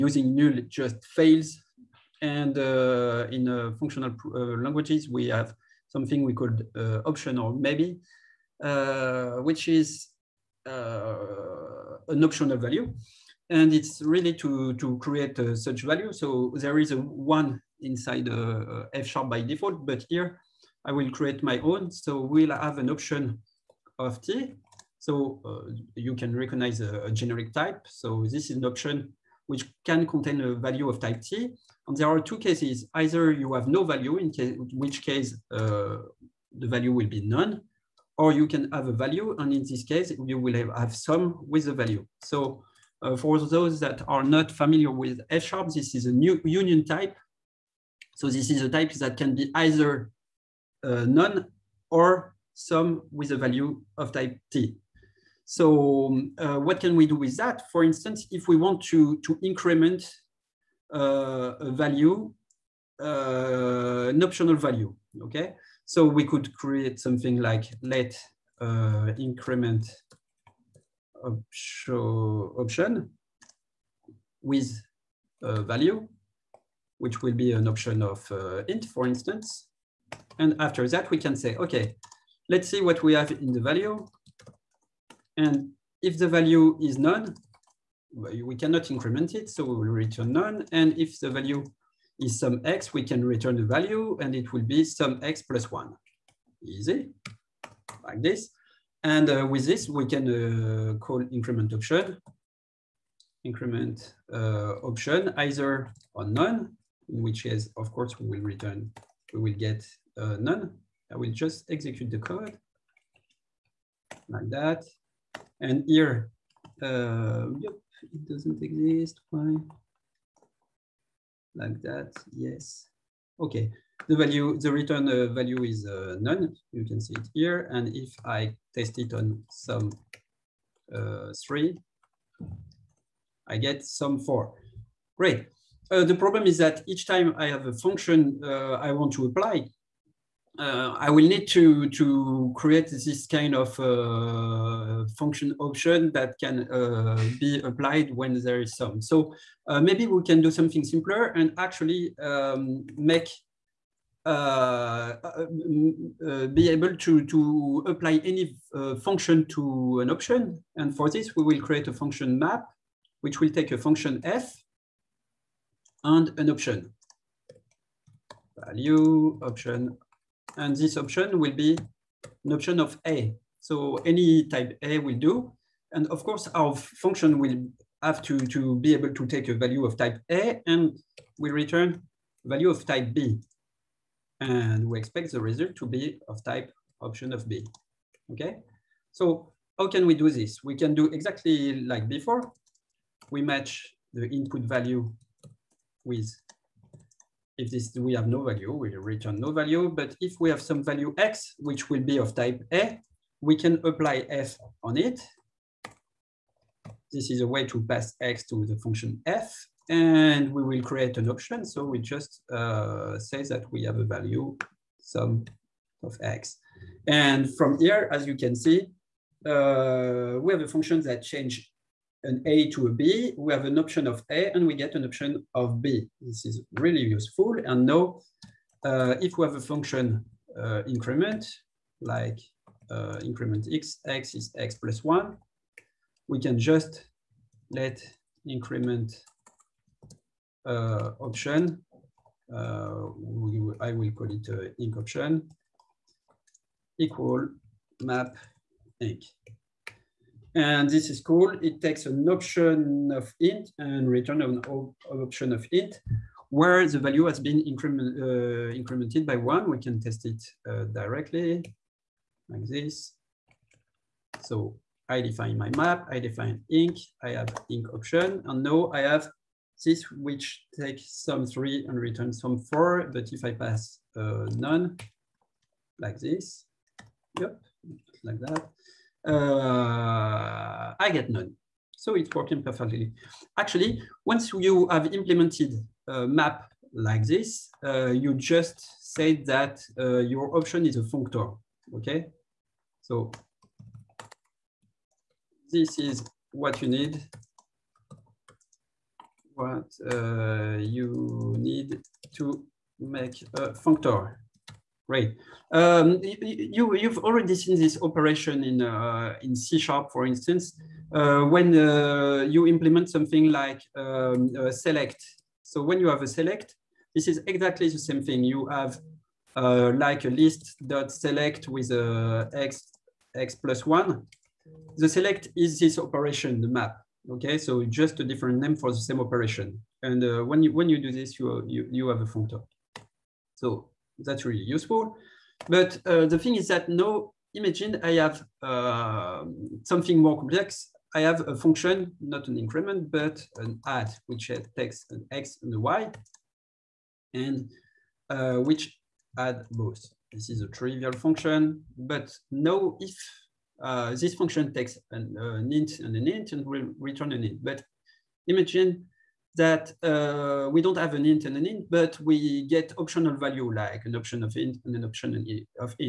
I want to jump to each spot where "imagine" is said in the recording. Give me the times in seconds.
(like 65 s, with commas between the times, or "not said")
337 s, 358 s.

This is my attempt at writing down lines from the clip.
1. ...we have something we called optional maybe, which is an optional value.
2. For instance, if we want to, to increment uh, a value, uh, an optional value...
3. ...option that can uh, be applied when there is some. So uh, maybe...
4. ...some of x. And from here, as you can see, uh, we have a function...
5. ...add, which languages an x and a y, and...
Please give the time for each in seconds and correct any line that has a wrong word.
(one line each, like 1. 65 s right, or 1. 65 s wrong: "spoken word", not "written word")
1. 5 s right
2. 57 s right
3. 145 s right
4. 215 s right
5. 343 s wrong: "takes", not "languages".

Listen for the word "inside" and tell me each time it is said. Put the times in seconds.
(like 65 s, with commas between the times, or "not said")
17 s.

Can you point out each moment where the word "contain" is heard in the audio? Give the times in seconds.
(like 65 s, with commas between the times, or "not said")
30 s.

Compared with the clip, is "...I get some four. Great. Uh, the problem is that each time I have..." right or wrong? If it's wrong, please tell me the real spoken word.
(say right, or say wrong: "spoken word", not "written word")
right.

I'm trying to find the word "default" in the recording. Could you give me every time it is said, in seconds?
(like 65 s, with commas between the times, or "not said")
19 s.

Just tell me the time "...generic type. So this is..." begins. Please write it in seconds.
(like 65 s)
27 s.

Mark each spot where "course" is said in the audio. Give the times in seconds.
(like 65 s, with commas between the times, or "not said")
107 s, 176 s.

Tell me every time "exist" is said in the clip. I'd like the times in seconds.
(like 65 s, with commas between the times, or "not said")
118 s.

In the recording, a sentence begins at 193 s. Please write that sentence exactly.
We match the input value with if this we have no value, we return no value.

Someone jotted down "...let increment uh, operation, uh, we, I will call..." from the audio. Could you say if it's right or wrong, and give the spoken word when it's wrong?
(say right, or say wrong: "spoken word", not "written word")
wrong: "option", not "operation".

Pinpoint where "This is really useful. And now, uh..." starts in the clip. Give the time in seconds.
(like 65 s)
226 s.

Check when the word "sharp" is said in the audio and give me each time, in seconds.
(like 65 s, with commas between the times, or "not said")
19 s, 45 s, 309 s.